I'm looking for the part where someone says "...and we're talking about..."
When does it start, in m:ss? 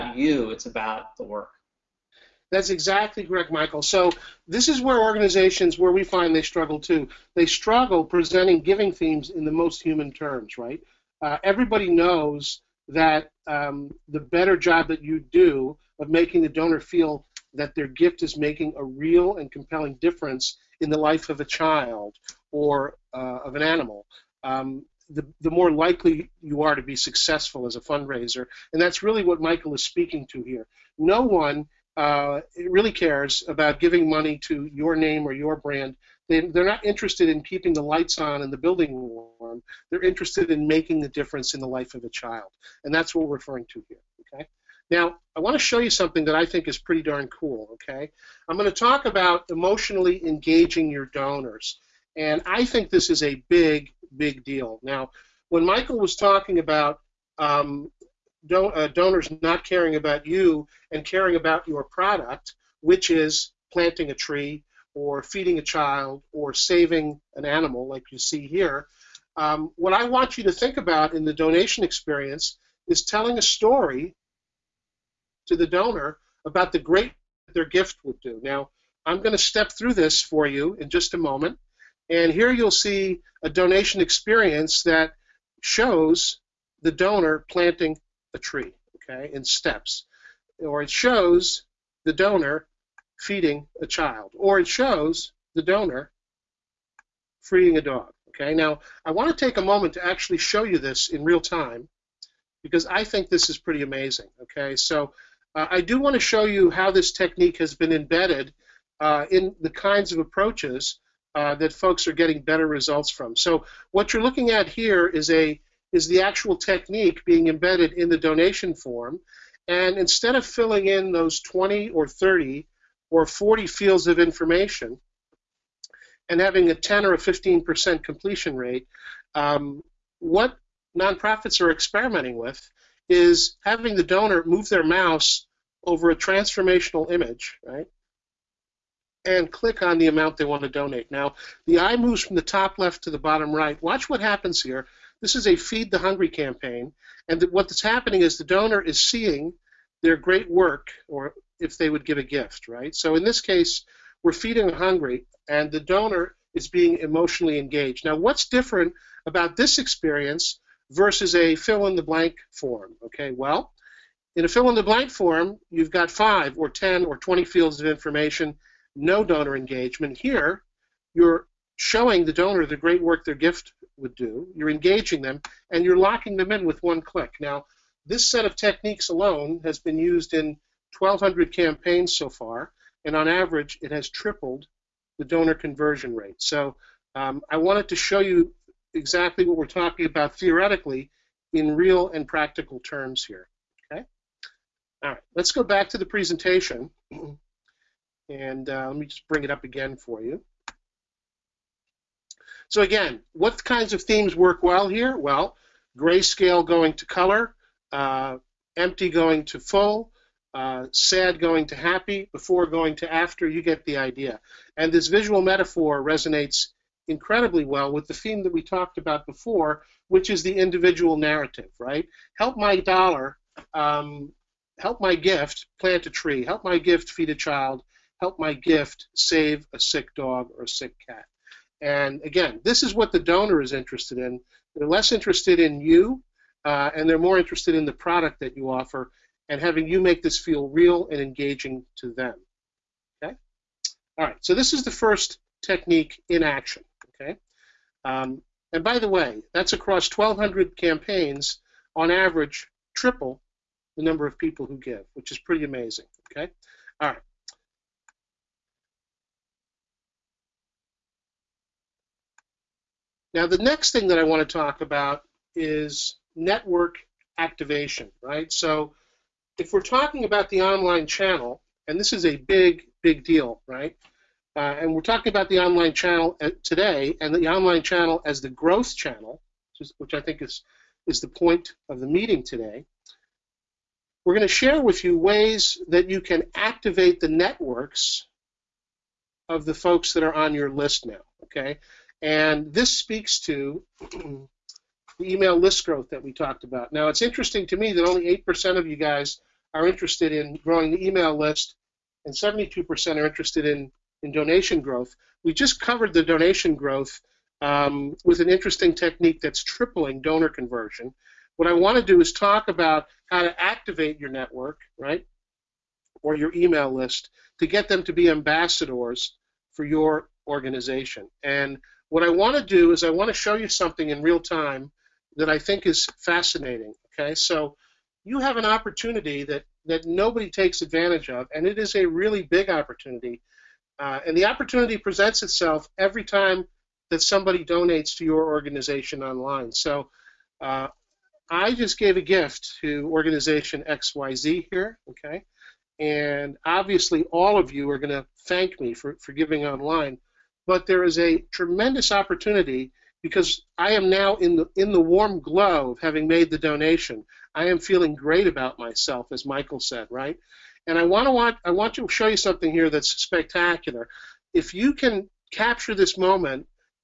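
4:34.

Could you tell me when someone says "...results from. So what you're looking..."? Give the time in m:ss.
1:52.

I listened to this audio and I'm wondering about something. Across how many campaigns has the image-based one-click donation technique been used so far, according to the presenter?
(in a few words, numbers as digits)
1,200.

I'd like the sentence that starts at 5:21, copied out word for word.
And what I want to do is I want to show you something in real time that I think is fascinating.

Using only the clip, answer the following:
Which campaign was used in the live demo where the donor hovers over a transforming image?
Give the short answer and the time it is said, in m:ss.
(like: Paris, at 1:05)
Feed the Hungry, at 2:25.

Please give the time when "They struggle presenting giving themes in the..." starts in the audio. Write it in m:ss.
0:07.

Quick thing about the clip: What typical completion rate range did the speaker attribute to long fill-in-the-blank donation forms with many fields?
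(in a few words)
10 or 15%.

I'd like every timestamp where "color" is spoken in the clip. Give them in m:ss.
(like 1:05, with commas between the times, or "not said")
3:27.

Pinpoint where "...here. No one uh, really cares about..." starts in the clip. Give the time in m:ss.
0:30.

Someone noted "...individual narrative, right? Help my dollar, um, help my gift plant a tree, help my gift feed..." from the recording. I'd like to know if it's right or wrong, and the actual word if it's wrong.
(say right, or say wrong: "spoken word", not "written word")
right.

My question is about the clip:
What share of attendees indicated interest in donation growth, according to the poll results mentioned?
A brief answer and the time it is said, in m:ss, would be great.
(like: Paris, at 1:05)
72%, at 5:02.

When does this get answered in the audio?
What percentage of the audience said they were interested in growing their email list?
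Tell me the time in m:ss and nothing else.
4:58.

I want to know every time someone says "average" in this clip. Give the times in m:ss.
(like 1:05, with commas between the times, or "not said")
3:03, 4:12.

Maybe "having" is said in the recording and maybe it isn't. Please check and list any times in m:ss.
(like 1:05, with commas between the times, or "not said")
2:06, 2:13, 3:59, 5:55.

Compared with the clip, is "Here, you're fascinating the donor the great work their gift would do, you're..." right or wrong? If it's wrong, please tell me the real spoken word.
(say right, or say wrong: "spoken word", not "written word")
wrong: "showing", not "fascinating".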